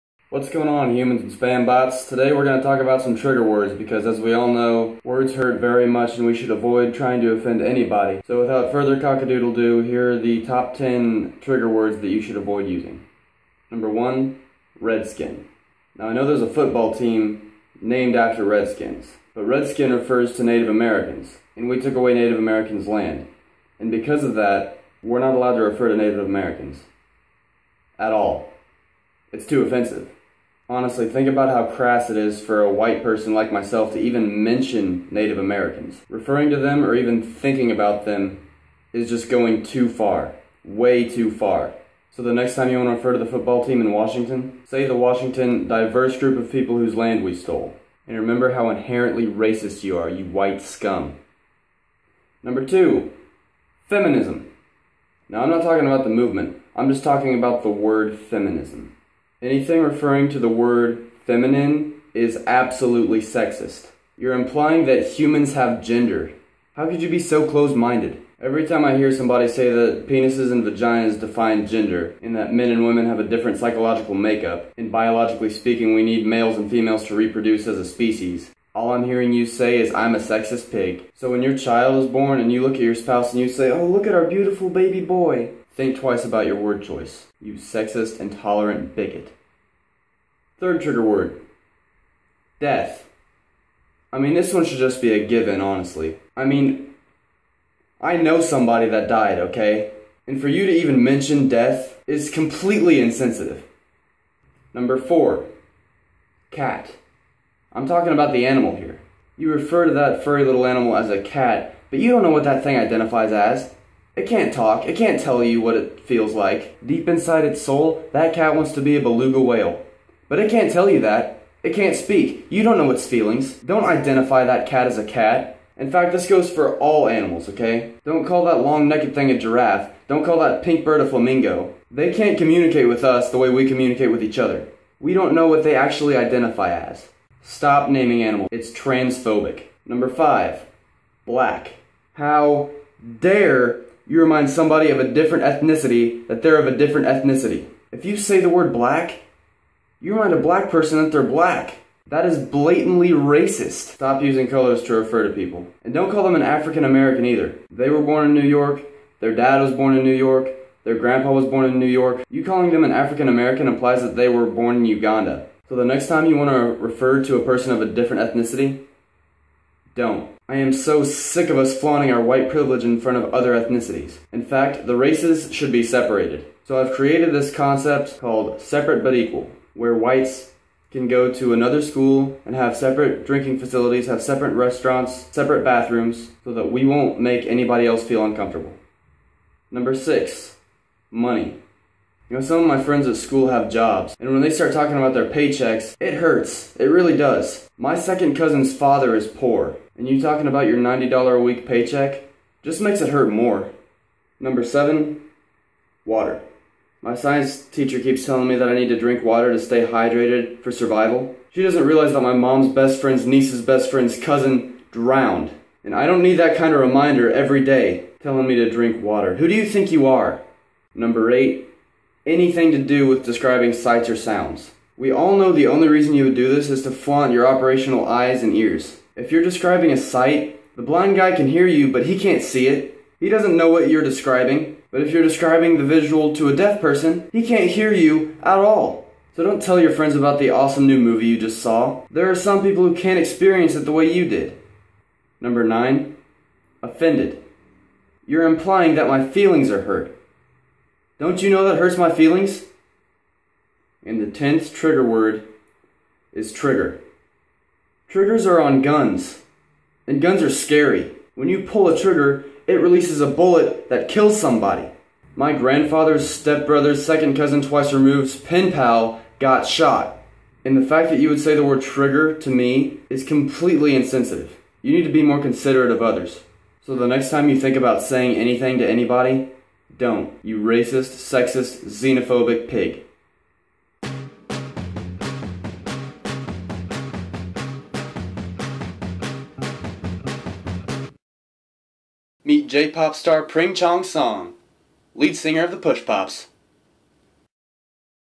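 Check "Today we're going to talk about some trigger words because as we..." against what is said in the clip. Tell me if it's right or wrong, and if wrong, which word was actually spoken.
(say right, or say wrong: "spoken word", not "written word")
right.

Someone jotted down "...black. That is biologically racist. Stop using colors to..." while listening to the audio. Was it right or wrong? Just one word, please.
wrong.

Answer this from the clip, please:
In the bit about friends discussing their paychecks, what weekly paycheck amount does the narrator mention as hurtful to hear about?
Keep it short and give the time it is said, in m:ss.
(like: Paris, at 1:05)
$90, at 3:20.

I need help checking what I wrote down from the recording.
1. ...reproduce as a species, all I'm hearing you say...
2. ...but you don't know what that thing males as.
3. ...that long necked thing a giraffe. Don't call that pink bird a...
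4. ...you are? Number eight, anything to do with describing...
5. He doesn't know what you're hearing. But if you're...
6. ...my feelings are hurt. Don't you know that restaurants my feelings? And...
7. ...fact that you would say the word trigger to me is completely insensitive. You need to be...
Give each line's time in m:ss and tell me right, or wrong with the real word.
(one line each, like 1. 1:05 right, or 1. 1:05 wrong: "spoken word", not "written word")
1. 1:17 right
2. 1:51 wrong: "identifies", not "males"
3. 2:08 right
4. 3:39 right
5. 3:53 wrong: "describing", not "hearing"
6. 4:09 wrong: "hurts", not "restaurants"
7. 4:30 right.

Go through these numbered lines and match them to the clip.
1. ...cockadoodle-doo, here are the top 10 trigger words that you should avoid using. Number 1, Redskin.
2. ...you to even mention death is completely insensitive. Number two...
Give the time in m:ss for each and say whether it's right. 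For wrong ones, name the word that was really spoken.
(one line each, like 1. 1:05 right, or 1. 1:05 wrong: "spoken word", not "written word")
1. 0:08 right
2. 1:40 wrong: "four", not "two".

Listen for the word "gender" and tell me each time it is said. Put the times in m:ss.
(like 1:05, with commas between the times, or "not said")
1:05, 1:11.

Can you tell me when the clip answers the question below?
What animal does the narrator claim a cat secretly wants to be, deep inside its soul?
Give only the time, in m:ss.
1:59.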